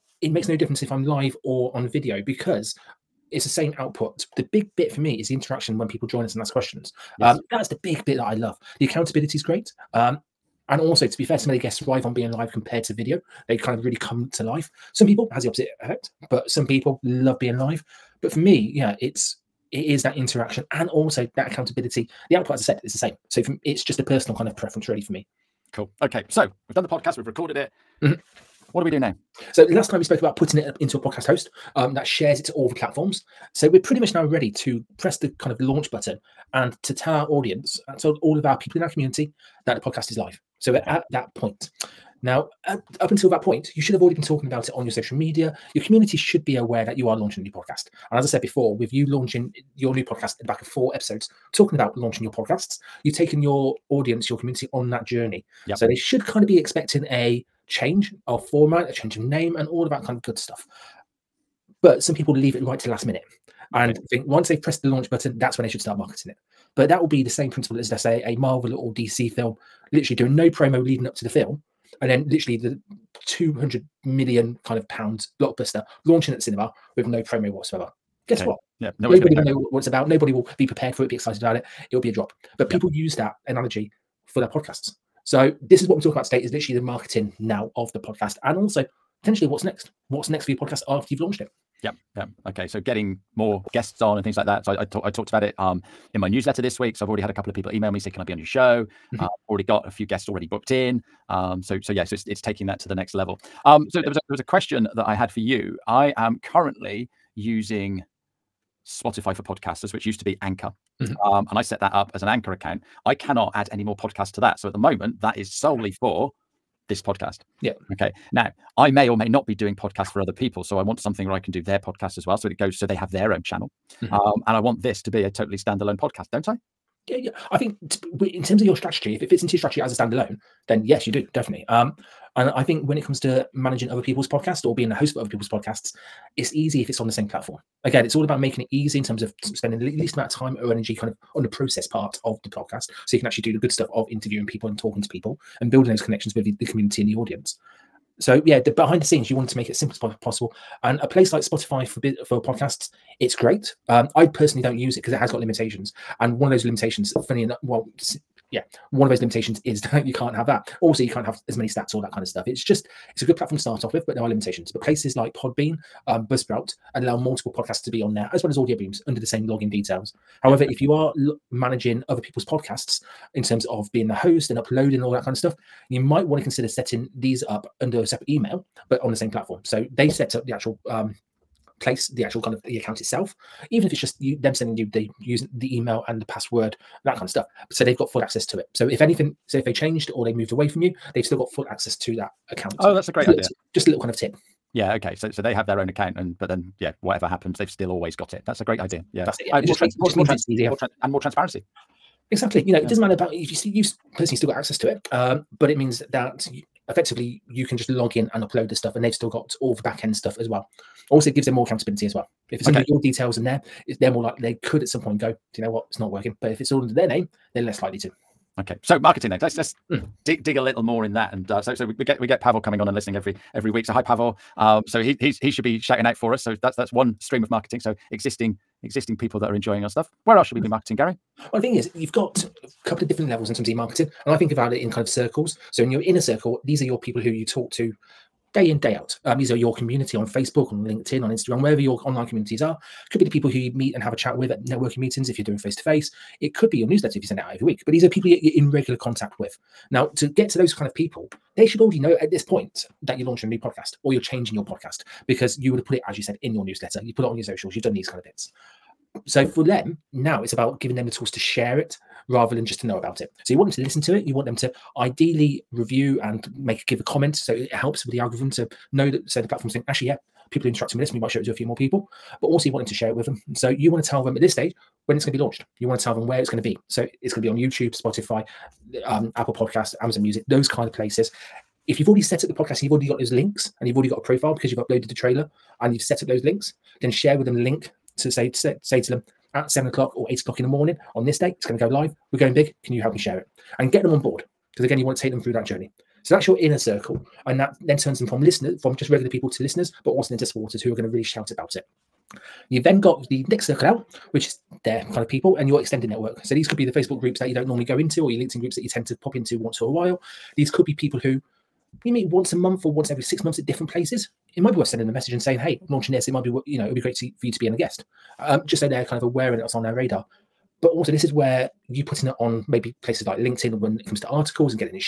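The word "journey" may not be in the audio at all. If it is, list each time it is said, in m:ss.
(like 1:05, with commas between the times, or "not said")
0:55, 4:55.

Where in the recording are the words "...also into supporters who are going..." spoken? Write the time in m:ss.
5:00.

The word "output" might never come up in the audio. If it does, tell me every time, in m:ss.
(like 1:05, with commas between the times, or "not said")
0:03, 0:22.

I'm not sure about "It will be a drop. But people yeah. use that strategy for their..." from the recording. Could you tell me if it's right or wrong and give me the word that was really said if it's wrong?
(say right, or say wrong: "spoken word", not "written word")
wrong: "analogy", not "strategy".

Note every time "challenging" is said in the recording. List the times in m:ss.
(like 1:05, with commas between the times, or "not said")
not said.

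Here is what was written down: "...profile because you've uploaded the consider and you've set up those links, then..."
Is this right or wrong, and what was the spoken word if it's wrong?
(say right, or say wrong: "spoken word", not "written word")
wrong: "trailer", not "consider".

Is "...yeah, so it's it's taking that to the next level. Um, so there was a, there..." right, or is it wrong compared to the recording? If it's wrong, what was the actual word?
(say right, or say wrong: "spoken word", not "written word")
right.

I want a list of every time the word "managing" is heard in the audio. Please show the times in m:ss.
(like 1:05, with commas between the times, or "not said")
2:13, 2:51.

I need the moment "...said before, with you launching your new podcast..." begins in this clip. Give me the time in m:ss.
0:48.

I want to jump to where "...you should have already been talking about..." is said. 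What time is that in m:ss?
0:43.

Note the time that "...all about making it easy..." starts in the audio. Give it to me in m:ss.
2:18.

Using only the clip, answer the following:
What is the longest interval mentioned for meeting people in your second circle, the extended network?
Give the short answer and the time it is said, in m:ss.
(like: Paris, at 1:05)
Every six months, at 5:12.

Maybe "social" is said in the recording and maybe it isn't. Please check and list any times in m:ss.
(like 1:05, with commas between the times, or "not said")
0:44, 4:17.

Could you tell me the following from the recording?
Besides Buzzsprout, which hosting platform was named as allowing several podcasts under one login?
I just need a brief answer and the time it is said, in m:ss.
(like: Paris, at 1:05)
Podbean, at 2:45.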